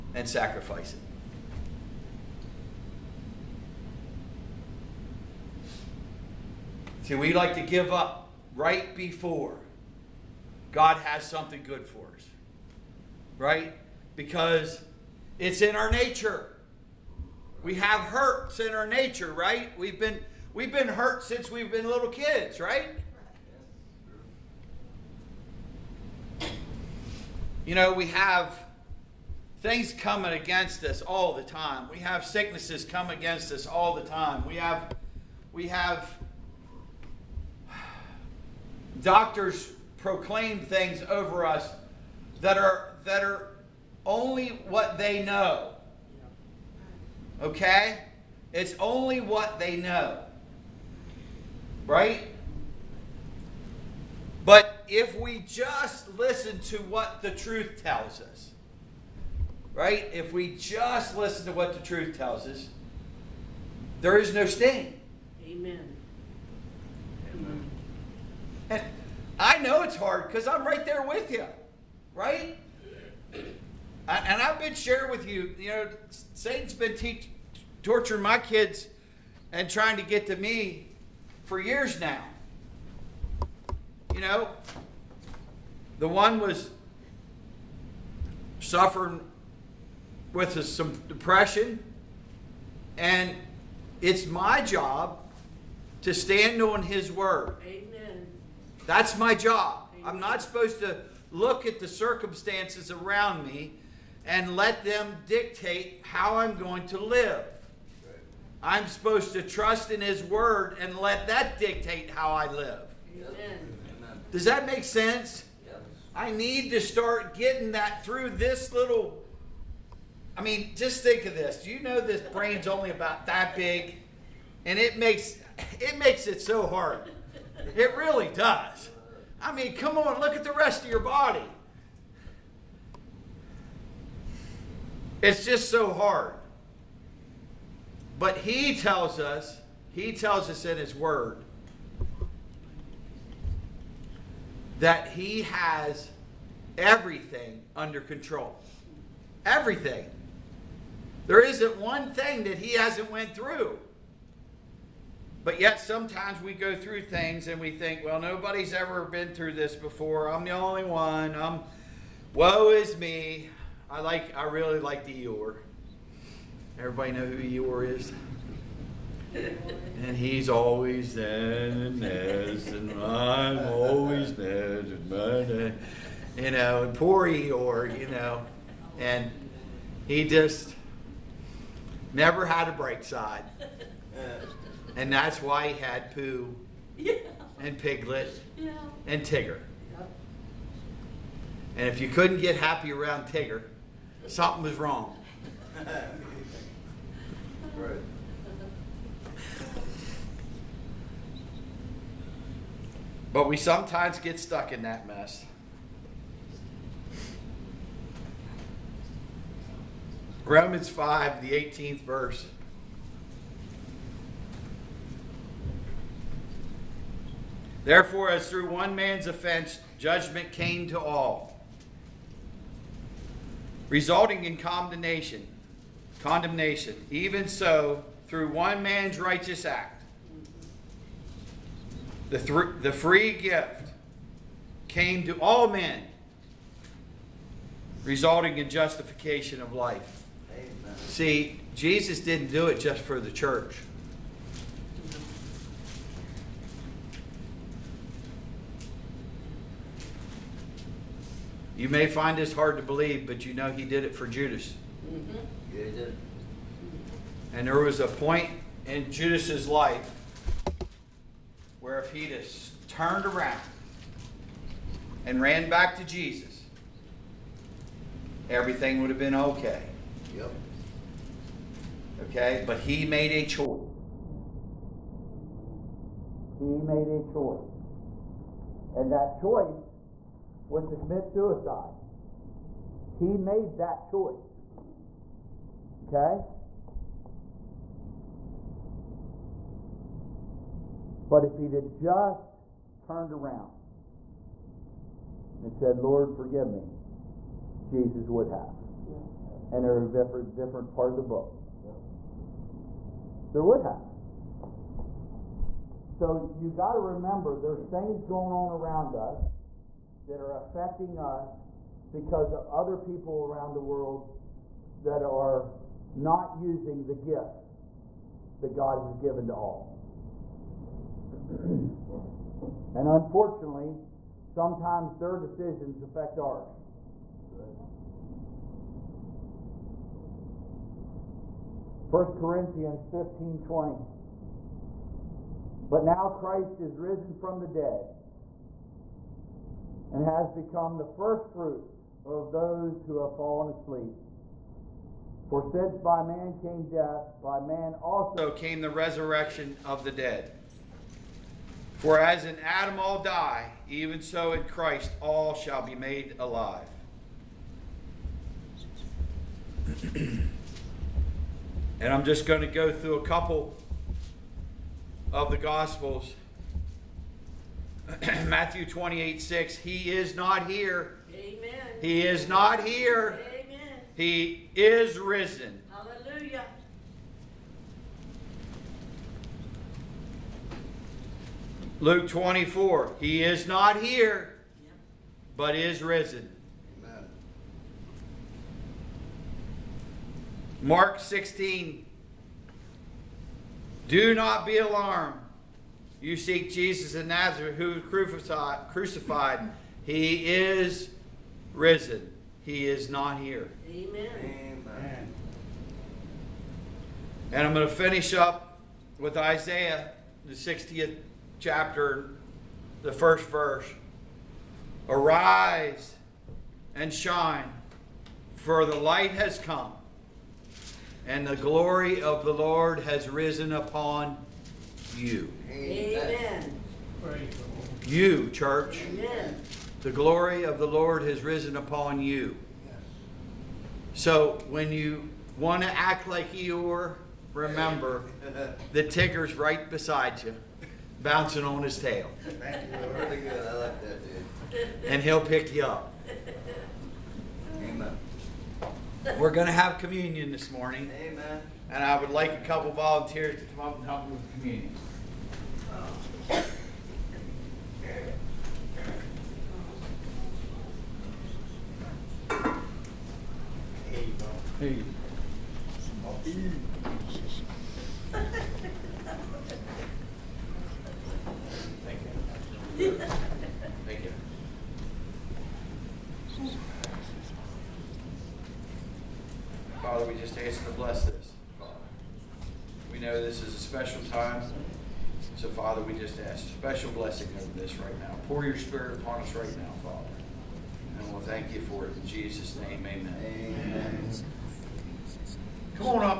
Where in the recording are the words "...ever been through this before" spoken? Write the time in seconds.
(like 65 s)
158 s.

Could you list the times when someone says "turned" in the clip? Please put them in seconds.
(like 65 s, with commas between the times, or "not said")
262 s, 292 s.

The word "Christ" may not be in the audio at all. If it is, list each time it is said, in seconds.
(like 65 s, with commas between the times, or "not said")
336 s, 354 s.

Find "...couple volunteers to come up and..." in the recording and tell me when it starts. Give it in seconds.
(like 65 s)
452 s.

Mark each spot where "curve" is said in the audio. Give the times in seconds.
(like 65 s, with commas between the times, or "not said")
not said.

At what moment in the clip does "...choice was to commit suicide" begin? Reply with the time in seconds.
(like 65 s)
279 s.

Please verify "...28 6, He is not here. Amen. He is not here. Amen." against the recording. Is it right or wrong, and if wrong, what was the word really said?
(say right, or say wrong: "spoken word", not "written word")
right.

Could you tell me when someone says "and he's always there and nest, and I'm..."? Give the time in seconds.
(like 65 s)
169 s.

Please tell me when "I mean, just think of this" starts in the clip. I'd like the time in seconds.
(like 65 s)
120 s.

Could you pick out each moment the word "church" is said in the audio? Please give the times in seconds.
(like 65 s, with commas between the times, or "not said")
243 s, 428 s.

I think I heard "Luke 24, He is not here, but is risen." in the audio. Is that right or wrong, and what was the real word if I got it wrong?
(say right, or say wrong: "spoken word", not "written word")
right.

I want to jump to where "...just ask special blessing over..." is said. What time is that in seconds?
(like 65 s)
486 s.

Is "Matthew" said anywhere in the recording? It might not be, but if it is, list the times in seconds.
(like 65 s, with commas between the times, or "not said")
368 s.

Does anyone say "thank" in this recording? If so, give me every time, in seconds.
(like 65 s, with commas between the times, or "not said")
442 s, 491 s.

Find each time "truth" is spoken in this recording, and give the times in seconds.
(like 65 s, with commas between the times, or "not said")
57 s, 61 s.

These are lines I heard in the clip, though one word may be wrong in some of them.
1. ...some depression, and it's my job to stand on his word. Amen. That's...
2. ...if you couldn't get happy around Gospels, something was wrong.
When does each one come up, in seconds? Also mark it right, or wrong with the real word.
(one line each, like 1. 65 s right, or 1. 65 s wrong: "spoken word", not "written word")
1. 90 s right
2. 191 s wrong: "Tigger", not "Gospels".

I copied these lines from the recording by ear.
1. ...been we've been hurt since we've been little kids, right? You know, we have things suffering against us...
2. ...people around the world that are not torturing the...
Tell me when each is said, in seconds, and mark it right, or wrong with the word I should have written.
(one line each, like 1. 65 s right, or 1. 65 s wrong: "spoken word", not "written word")
1. 19 s wrong: "coming", not "suffering"
2. 312 s wrong: "using", not "torturing".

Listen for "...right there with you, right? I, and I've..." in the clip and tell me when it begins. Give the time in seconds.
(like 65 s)
70 s.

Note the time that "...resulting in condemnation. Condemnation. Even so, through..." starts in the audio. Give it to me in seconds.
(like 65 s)
223 s.